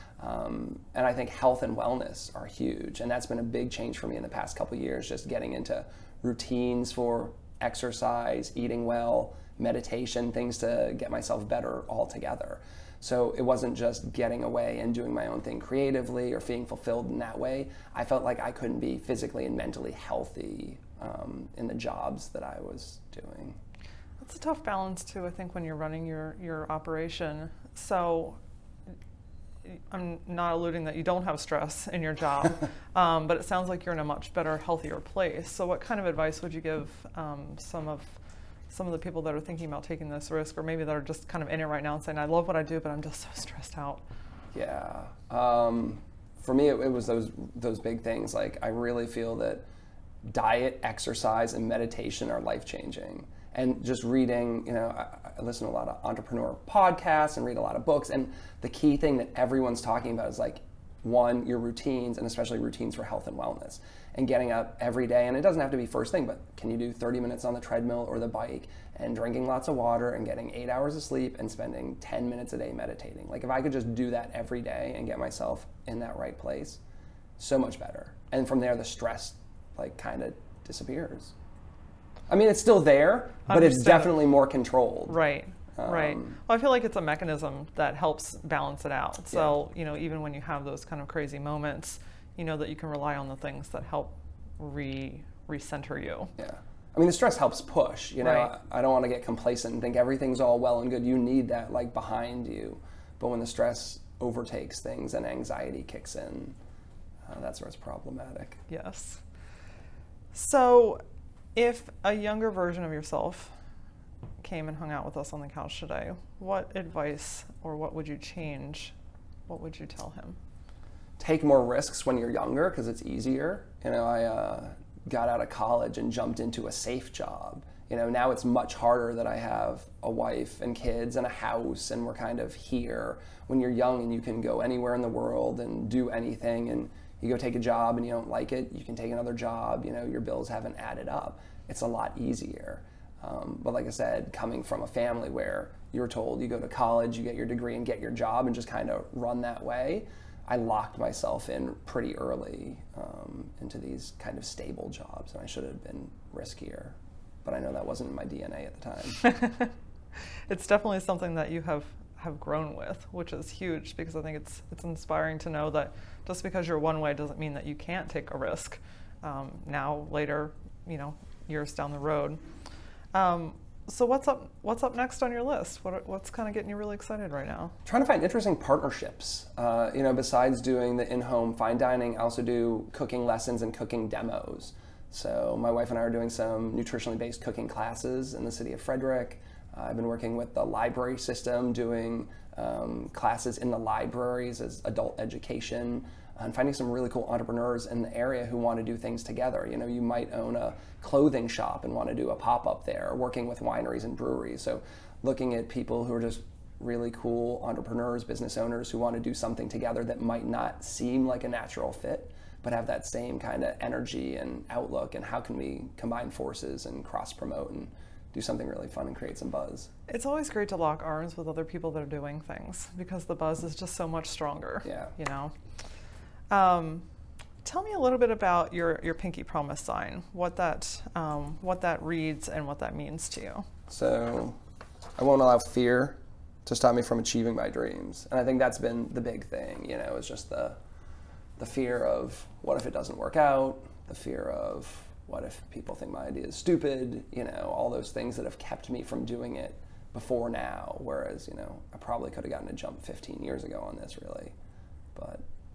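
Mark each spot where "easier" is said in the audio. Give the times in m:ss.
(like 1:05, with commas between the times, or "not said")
2:03, 2:22.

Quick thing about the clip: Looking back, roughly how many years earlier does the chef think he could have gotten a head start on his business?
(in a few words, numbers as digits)
15 years.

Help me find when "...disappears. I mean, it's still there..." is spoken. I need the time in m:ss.
1:20.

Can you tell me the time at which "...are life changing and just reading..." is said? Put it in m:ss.
0:52.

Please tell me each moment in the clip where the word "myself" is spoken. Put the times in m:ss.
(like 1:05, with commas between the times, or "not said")
0:11, 1:15, 2:30.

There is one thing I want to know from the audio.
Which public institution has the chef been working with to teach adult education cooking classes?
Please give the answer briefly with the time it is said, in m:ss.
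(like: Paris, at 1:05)
The library system, at 3:10.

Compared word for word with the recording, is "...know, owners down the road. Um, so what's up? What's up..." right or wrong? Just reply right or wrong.
wrong.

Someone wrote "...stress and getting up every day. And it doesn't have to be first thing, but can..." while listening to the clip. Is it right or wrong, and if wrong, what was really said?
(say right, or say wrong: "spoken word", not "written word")
wrong: "wellness", not "stress".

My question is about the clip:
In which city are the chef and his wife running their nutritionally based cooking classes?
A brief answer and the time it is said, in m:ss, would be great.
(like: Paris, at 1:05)
Frederick, at 3:08.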